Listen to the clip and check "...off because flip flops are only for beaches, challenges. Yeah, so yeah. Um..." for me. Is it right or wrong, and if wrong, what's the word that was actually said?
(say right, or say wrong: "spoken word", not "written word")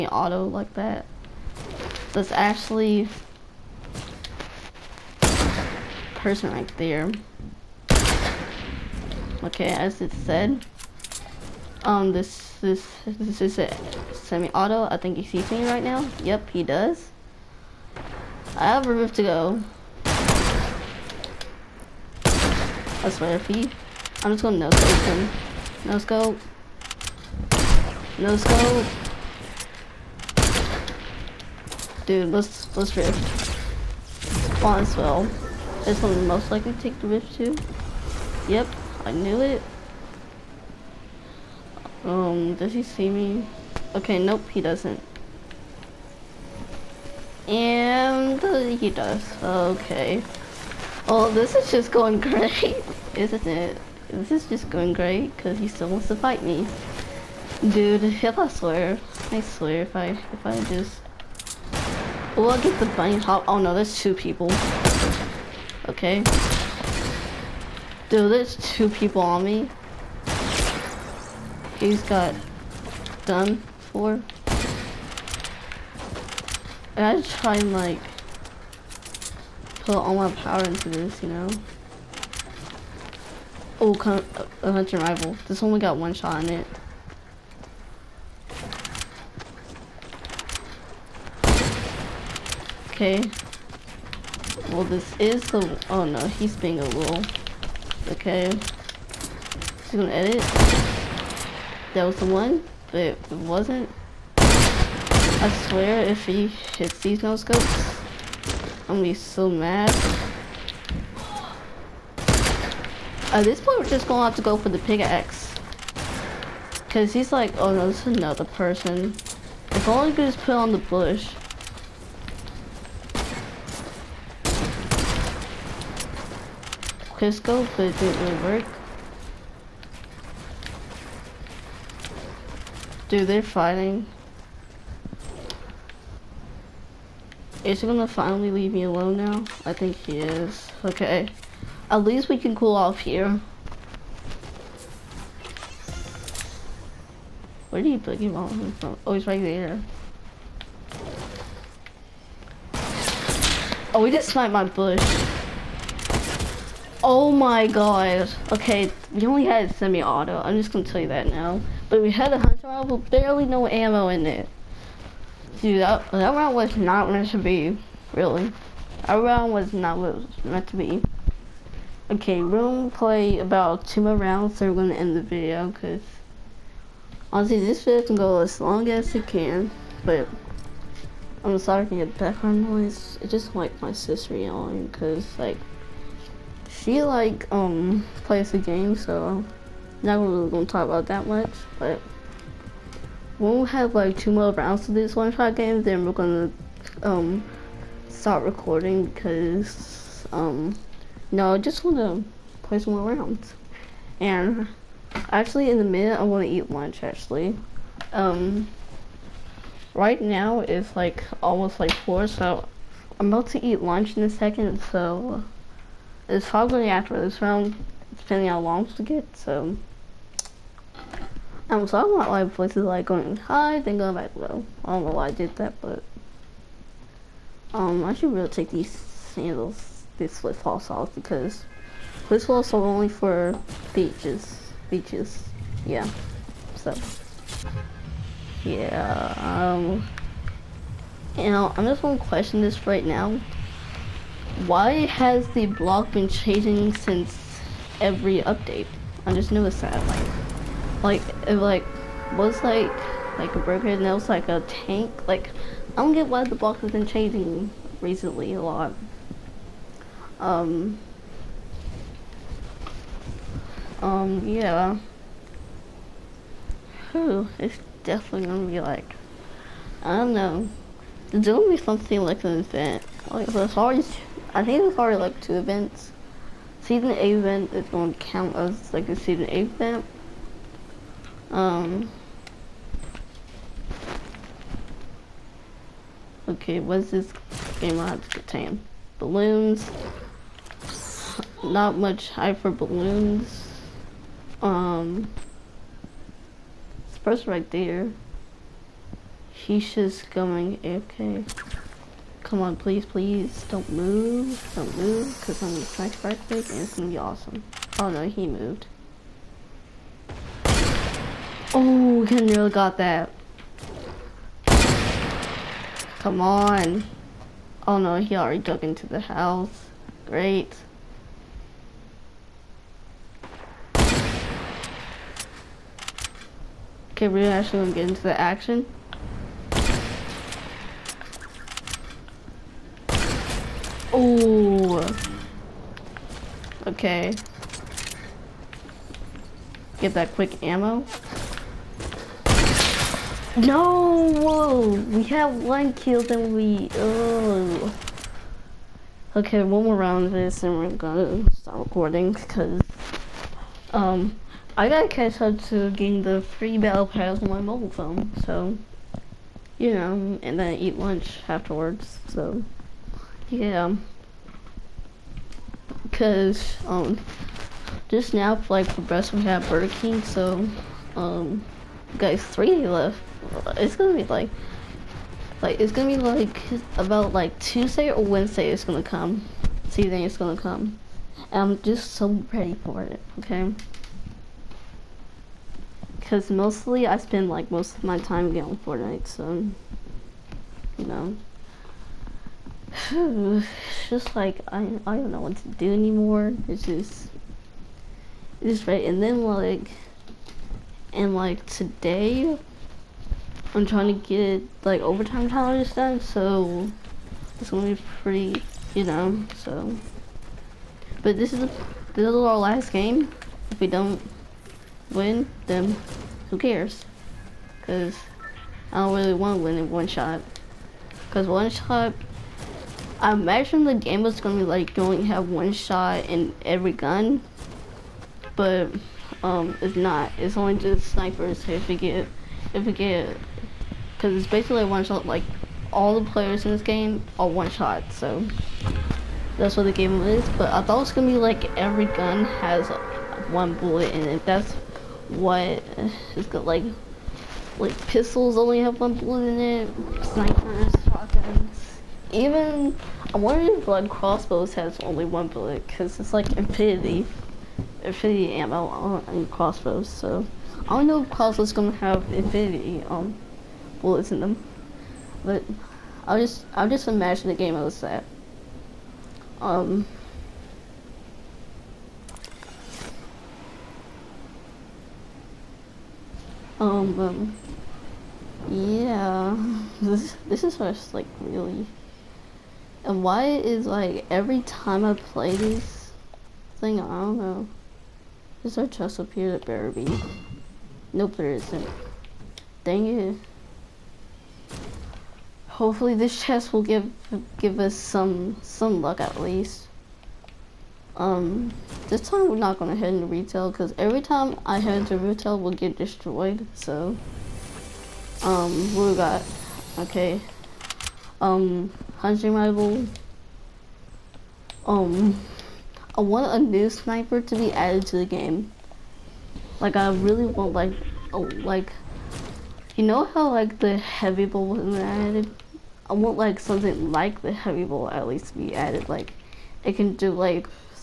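wrong: "beaches", not "challenges".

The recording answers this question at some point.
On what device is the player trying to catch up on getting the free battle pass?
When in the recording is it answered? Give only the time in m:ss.
5:57.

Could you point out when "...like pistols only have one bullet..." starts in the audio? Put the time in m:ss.
7:27.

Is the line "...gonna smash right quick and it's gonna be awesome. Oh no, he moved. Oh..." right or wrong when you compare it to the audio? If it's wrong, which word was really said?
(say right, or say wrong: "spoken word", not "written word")
right.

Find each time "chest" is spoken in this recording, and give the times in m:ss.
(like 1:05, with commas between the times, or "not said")
8:08, 8:16.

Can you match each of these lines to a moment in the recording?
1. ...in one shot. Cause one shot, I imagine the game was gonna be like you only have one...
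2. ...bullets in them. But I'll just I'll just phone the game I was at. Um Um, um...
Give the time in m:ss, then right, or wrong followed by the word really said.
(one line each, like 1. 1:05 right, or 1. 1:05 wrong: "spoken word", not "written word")
1. 6:59 right
2. 7:44 wrong: "imagine", not "phone".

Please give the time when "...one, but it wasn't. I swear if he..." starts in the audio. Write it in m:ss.
1:42.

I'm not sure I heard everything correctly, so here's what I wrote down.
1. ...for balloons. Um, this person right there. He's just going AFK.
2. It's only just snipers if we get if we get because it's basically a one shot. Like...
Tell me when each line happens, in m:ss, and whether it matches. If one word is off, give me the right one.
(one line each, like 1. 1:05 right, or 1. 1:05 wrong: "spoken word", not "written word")
1. 4:52 right
2. 7:10 right.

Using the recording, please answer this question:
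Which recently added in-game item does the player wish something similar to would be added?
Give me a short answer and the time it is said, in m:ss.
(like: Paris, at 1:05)
heavy bow, at 8:43.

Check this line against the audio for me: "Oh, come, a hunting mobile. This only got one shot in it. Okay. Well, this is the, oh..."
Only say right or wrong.
wrong.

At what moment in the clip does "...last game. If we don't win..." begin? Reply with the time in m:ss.
6:52.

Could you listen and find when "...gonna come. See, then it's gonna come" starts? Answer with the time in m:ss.
6:18.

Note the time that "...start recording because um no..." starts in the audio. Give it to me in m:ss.
3:18.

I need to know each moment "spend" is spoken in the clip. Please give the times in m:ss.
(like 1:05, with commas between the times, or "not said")
6:27.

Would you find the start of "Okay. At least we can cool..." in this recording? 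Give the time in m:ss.
2:20.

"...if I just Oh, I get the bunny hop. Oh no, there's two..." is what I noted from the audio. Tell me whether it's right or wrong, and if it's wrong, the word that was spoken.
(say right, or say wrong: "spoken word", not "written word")
right.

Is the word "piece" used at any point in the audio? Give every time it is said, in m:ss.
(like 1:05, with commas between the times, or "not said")
not said.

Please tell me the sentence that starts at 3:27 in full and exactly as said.
Actually, um, right now it's like almost like four, so I'm about to eat lunch in a second.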